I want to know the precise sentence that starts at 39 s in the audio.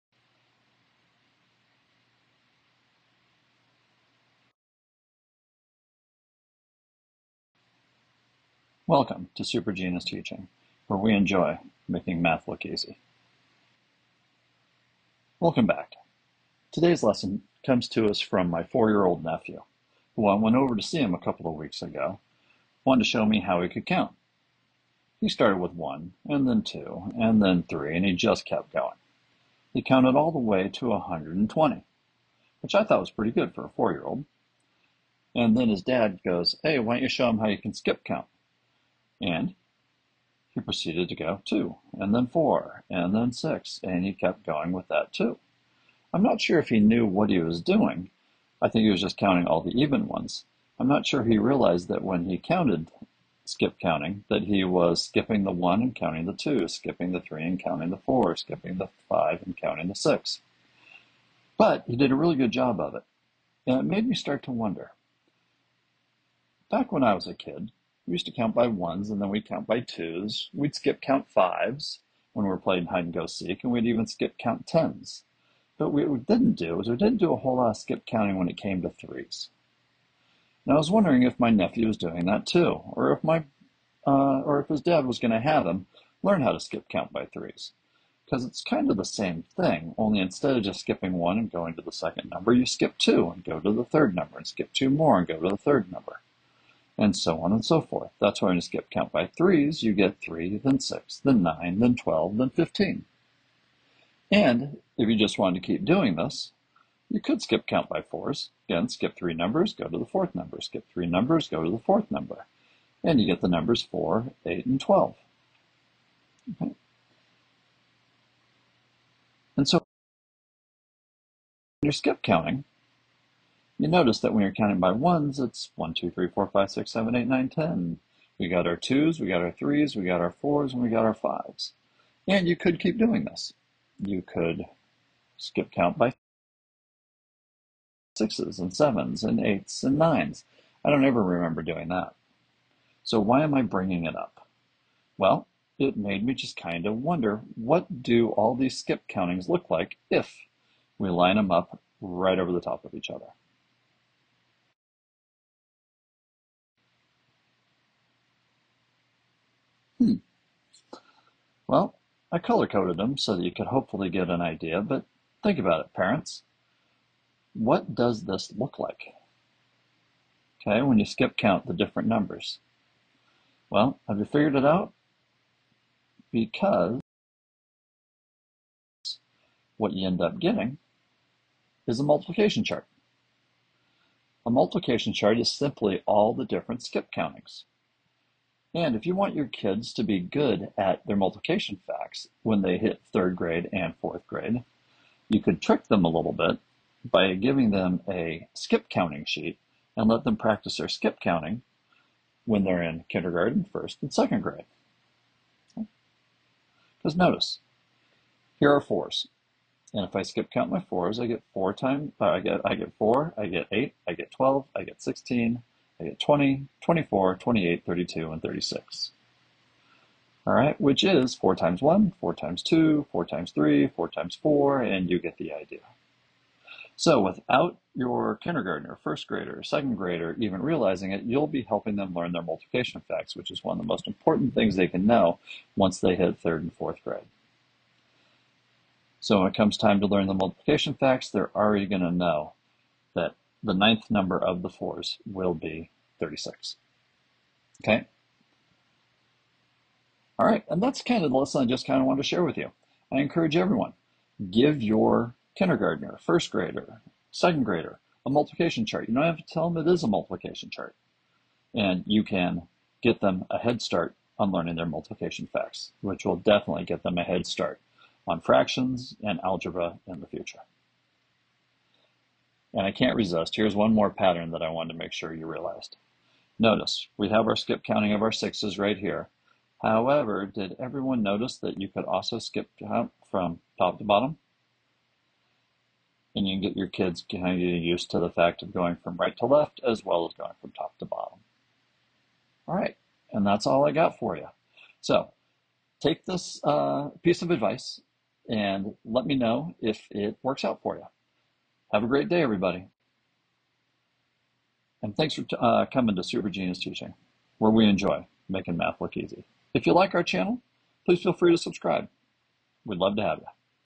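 And he proceeded to go two, and then four, and then six, and he kept going with that too.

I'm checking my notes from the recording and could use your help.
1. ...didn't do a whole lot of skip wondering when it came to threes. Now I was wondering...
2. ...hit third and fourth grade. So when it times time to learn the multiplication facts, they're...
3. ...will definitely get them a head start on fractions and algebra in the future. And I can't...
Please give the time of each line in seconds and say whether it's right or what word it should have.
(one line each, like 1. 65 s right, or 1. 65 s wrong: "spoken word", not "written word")
1. 76 s wrong: "counting", not "wondering"
2. 236 s wrong: "comes", not "times"
3. 266 s right.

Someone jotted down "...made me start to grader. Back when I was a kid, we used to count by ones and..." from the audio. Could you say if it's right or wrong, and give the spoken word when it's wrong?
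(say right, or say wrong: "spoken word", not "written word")
wrong: "wonder", not "grader".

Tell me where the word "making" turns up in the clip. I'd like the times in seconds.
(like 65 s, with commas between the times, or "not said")
11 s, 308 s.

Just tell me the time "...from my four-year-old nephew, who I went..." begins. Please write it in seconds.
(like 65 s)
18 s.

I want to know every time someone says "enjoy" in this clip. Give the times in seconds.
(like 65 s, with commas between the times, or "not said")
11 s, 307 s.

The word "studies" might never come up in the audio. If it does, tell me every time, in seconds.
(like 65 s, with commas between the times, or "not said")
not said.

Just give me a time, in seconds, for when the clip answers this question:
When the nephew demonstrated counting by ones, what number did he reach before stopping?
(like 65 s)
30 s.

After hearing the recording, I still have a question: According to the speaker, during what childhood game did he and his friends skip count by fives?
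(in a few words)
hide and go seek.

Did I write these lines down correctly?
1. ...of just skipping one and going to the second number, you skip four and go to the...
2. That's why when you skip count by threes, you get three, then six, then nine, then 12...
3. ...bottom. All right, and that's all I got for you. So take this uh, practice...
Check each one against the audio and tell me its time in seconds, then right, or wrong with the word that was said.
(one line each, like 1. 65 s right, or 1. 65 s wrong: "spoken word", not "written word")
1. 90 s wrong: "two", not "four"
2. 98 s right
3. 291 s wrong: "piece", not "practice".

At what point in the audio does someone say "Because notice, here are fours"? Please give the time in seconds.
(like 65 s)
206 s.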